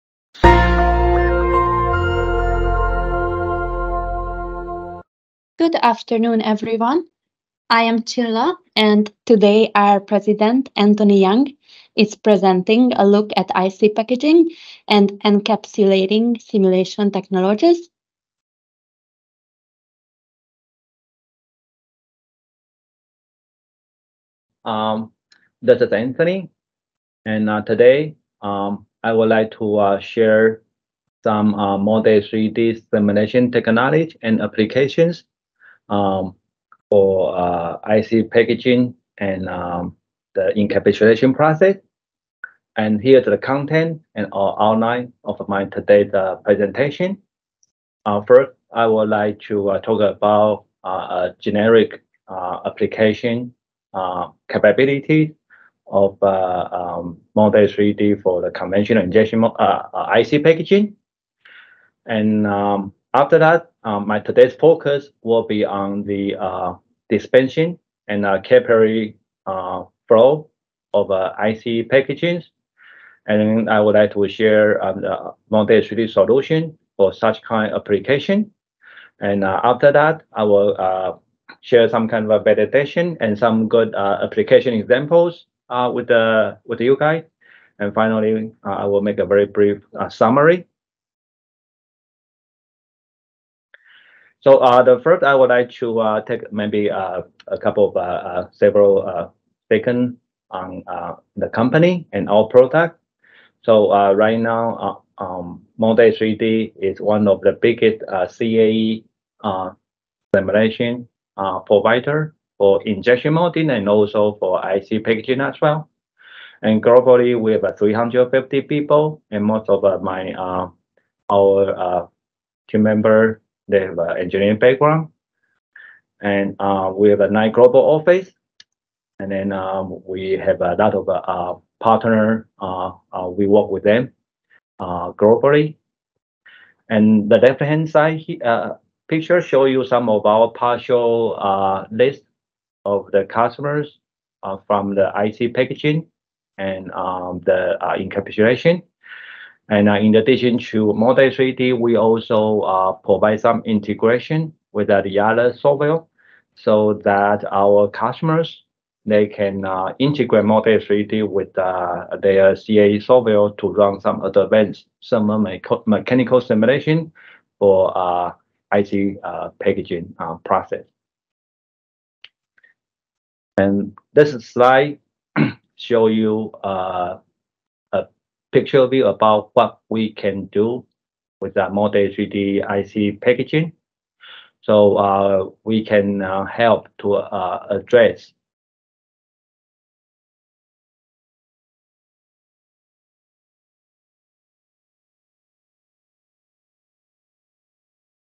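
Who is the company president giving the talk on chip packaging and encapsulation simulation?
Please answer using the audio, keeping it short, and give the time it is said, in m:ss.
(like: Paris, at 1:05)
Anthony Young, at 0:10.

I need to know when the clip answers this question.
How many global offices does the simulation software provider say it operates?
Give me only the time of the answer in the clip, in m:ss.
2:07.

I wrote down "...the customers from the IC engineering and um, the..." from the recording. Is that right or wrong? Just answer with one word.
wrong.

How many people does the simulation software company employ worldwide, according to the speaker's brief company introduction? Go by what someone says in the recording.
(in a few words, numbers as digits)
350.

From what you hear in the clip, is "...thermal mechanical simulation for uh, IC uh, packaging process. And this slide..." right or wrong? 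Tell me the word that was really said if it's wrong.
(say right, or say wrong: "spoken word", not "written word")
right.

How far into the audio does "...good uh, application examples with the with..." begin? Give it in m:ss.
1:23.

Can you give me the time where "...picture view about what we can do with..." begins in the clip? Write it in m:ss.
2:58.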